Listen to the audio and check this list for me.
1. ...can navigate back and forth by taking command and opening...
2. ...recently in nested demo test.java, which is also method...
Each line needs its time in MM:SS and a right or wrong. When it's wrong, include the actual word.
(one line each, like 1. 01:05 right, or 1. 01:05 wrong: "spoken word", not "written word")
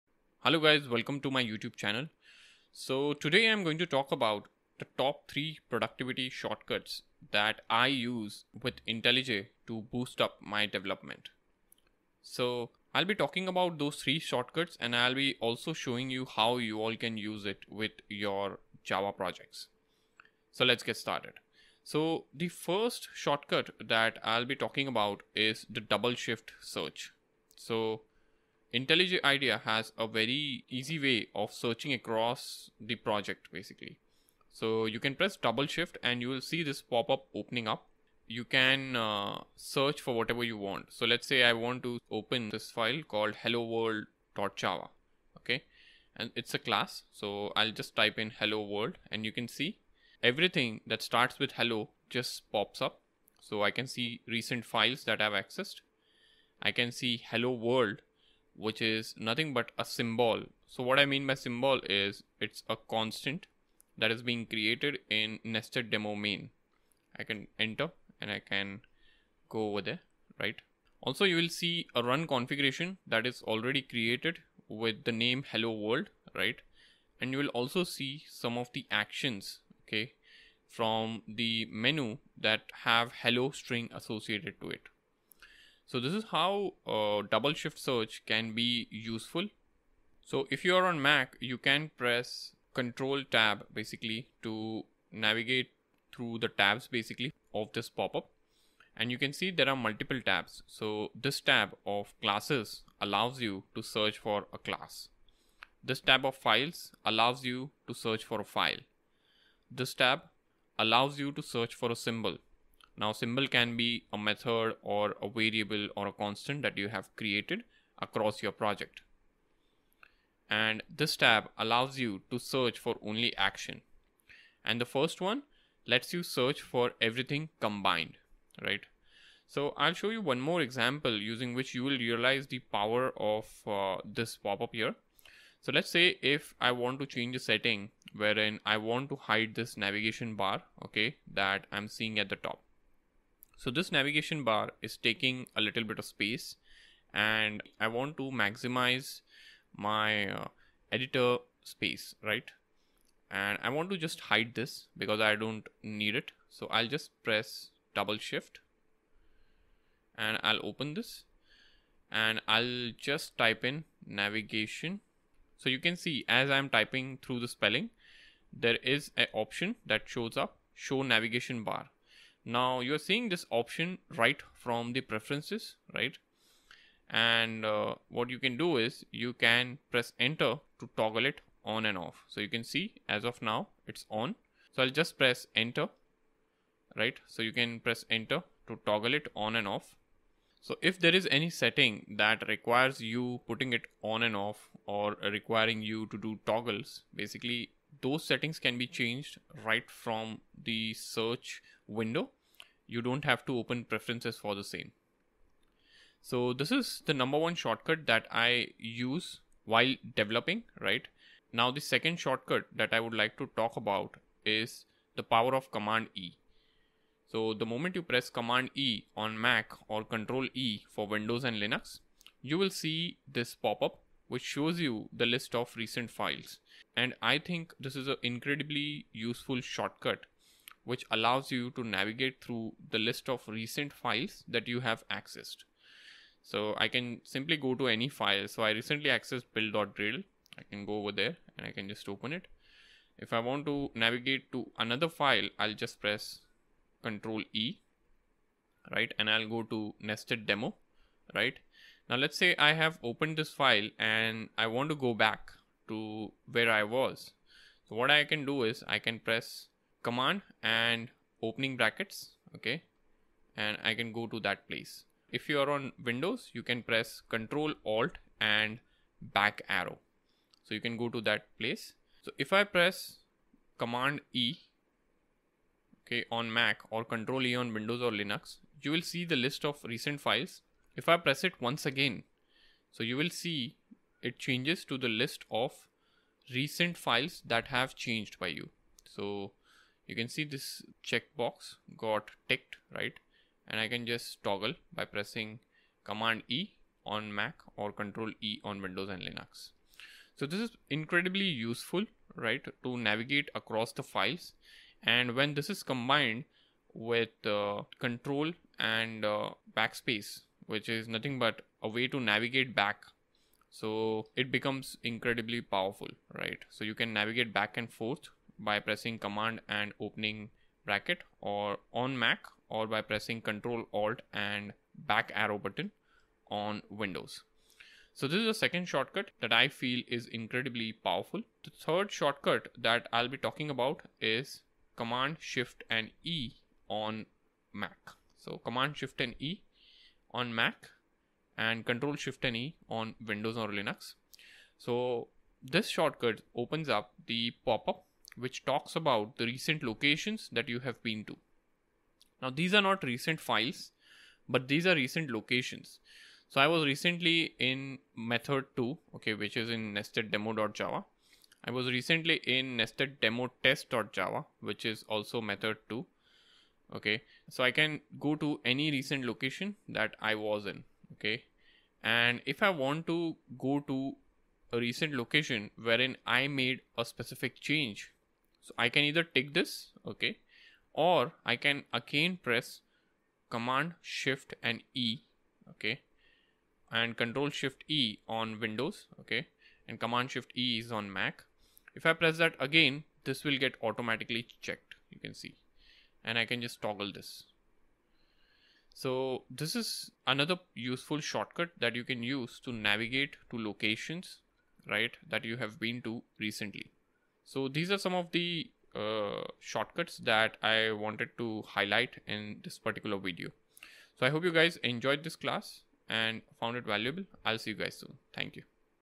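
1. 05:17 wrong: "pressing", not "taking"
2. 06:01 right.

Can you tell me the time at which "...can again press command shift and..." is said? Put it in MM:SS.
06:21.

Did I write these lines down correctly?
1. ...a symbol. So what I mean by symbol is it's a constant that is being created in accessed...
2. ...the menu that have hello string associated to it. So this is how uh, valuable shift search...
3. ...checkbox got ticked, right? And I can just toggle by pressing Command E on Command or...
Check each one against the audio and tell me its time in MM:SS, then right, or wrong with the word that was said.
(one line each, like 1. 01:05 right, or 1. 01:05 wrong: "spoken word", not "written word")
1. 00:59 wrong: "nested", not "accessed"
2. 01:21 wrong: "double", not "valuable"
3. 04:51 wrong: "Mac", not "Command".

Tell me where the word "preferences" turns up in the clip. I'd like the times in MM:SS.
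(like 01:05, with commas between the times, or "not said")
02:55, 03:23.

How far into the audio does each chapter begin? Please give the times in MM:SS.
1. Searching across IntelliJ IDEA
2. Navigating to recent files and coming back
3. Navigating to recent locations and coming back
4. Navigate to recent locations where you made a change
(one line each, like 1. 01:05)
1. 00:21
2. 03:31
3. 05:31
4. 06:11.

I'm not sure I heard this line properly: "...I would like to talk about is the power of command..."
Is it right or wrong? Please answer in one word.
right.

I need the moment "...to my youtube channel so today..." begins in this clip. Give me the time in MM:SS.
00:01.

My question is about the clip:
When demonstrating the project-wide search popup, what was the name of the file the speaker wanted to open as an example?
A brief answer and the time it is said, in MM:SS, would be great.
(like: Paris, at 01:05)
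hello world.java, at 00:43.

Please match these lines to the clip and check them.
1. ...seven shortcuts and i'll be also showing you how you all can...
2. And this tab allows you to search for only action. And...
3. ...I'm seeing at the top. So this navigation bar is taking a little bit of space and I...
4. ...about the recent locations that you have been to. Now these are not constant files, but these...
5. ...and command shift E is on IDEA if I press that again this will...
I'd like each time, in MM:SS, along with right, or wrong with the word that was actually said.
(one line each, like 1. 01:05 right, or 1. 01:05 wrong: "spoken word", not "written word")
1. 00:13 wrong: "three", not "seven"
2. 02:00 right
3. 02:21 right
4. 05:48 wrong: "recent", not "constant"
5. 06:29 wrong: "Mac", not "IDEA".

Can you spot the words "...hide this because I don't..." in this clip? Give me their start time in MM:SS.
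02:34.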